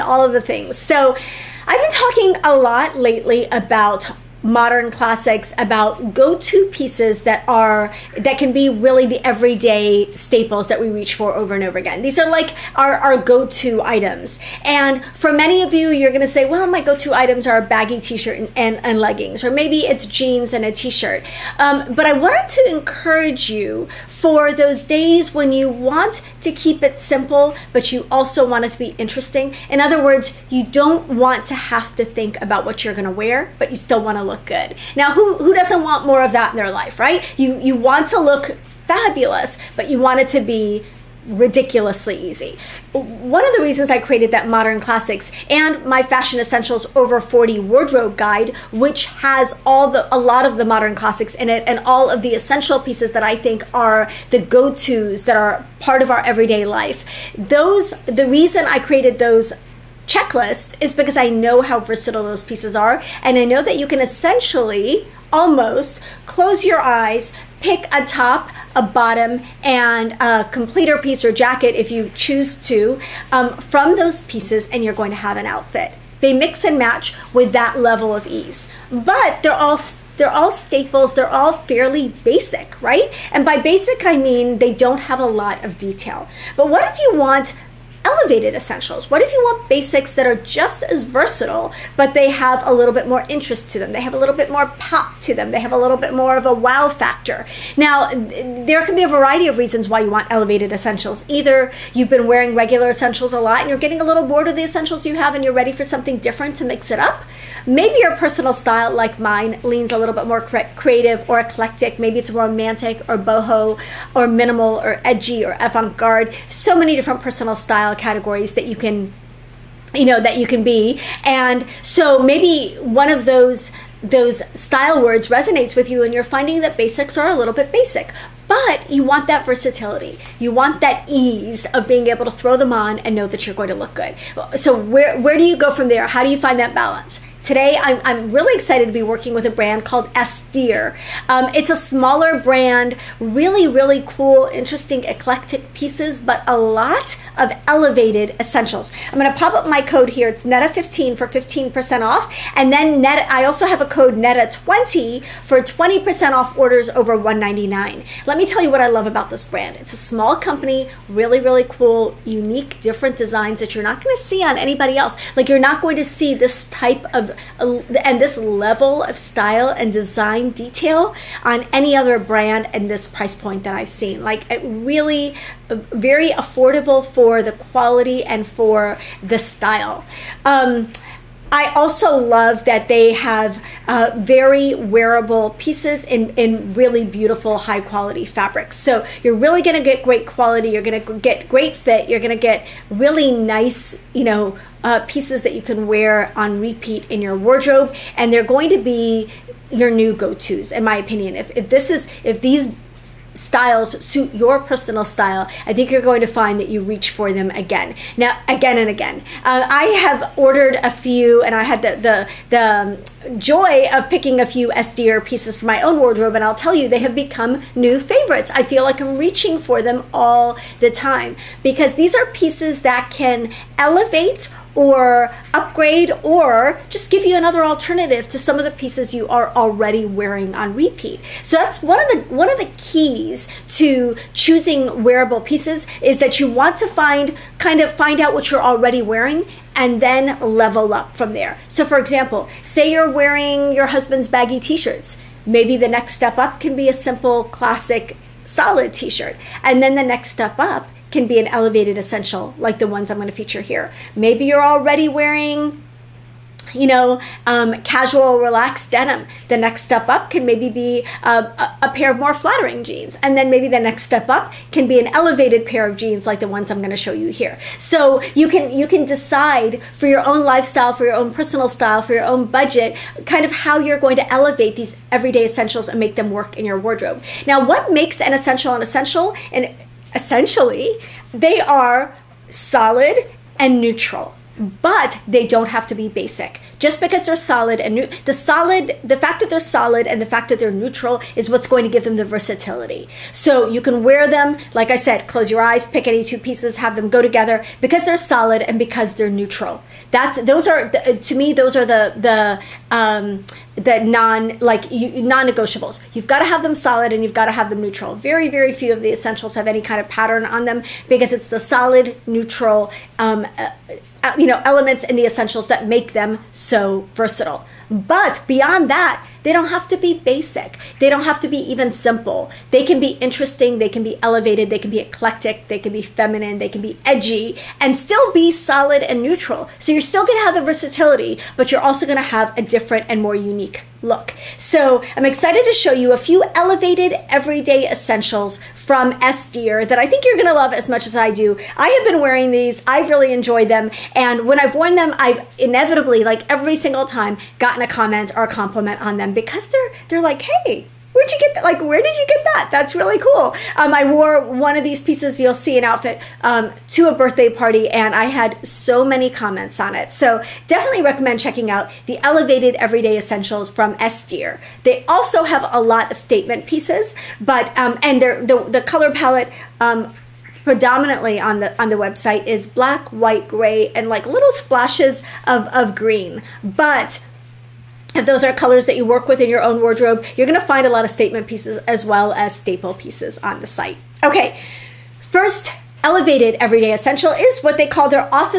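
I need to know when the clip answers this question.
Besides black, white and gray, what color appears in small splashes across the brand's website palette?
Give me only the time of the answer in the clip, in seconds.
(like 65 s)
375 s.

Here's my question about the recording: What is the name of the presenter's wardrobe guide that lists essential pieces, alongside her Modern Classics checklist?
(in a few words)
Fashion Essentials Over 40.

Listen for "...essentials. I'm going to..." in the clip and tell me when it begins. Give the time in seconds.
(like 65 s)
148 s.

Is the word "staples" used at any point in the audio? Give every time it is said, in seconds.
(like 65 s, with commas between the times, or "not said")
10 s, 80 s, 382 s.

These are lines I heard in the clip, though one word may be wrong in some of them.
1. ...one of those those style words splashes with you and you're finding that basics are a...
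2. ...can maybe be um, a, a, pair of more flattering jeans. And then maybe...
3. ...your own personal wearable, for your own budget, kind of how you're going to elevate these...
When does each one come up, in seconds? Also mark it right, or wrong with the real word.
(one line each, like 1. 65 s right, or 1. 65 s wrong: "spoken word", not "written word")
1. 122 s wrong: "resonates", not "splashes"
2. 260 s right
3. 271 s wrong: "style", not "wearable".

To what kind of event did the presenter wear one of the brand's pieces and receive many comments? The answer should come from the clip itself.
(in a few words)
A birthday party.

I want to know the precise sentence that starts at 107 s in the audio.
Maybe your personal style, like mine, leans a little bit more creative or eclectic.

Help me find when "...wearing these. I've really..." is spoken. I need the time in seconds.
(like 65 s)
342 s.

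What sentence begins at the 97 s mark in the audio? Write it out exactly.
Now, there can be a variety of reasons why you want elevated essentials.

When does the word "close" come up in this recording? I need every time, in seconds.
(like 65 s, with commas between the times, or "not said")
66 s, 295 s.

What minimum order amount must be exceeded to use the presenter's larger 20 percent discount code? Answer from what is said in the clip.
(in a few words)
$199.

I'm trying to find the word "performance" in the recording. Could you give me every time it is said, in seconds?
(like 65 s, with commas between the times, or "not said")
not said.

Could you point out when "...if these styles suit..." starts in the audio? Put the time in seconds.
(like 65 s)
202 s.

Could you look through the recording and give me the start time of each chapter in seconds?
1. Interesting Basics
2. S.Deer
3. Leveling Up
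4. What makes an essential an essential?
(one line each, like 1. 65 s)
1. 92 s
2. 142 s
3. 228 s
4. 278 s.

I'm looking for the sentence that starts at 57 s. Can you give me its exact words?
Those the reason I created those checklist is because I know how versatile those pieces are.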